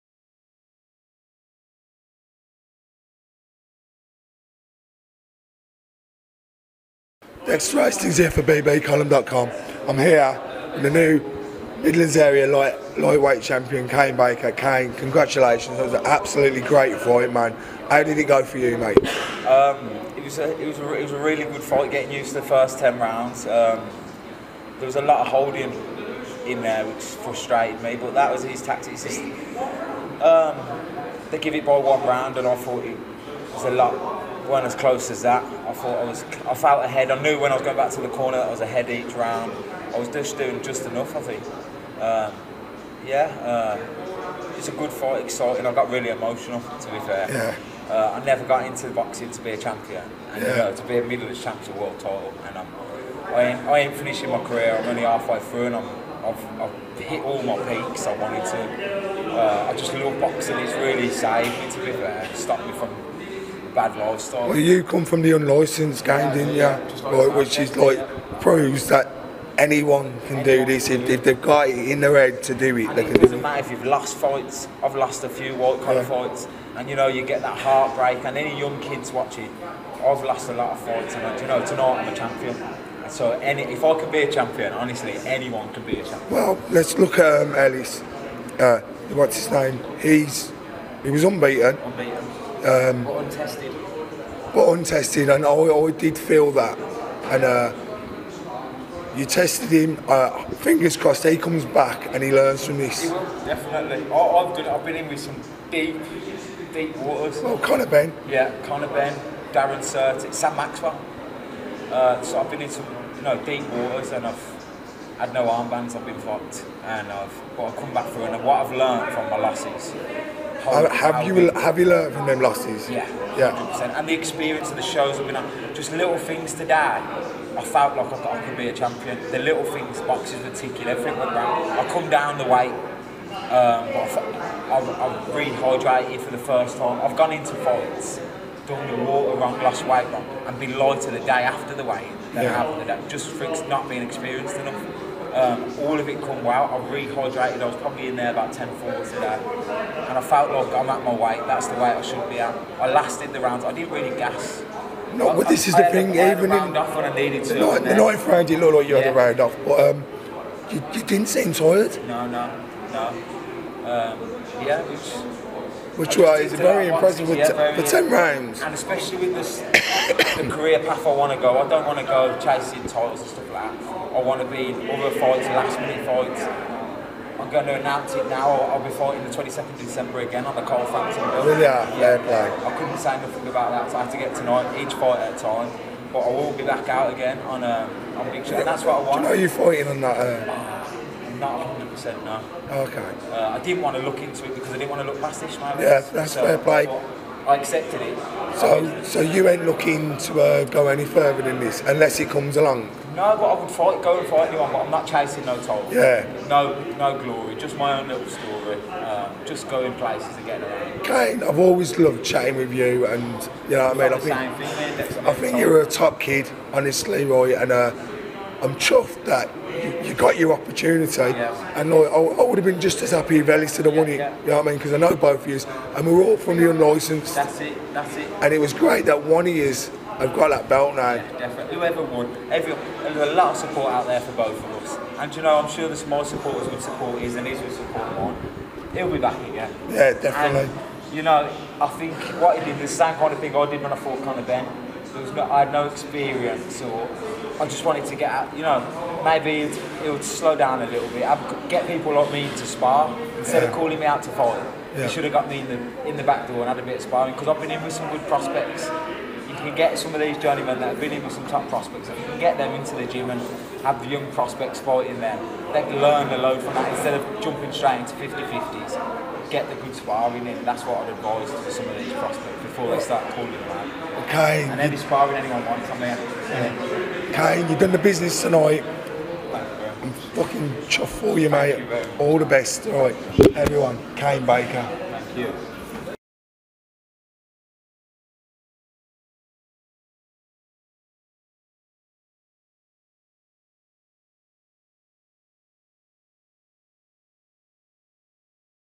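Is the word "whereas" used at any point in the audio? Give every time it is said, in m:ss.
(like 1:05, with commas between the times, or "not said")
not said.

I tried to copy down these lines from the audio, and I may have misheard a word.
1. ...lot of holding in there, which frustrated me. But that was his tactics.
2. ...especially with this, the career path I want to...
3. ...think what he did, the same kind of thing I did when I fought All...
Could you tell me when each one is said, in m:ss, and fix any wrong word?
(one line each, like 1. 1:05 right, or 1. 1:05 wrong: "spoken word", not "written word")
1. 0:25 right
2. 2:48 right
3. 4:01 wrong: "Conor", not "All".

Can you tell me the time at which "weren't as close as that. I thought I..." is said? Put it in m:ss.
0:34.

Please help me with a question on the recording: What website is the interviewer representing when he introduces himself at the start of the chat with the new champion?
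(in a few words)
bbcolumn.com.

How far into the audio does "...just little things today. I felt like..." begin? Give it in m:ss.
2:05.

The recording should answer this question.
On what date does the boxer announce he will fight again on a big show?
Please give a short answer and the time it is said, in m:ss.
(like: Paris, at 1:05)
22 December, at 2:59.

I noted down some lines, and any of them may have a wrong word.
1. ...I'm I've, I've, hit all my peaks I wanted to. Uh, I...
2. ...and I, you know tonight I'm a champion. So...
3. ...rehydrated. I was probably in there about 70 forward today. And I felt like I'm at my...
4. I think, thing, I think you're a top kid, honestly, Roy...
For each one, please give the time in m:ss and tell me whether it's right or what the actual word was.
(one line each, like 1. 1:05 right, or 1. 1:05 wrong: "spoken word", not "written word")
1. 0:55 right
2. 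1:21 right
3. 2:26 wrong: "10", not "70"
4. 3:34 right.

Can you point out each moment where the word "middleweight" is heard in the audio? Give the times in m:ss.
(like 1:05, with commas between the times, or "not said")
0:51.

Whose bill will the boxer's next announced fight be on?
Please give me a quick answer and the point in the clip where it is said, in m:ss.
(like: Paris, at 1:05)
Carl Frampton, at 3:00.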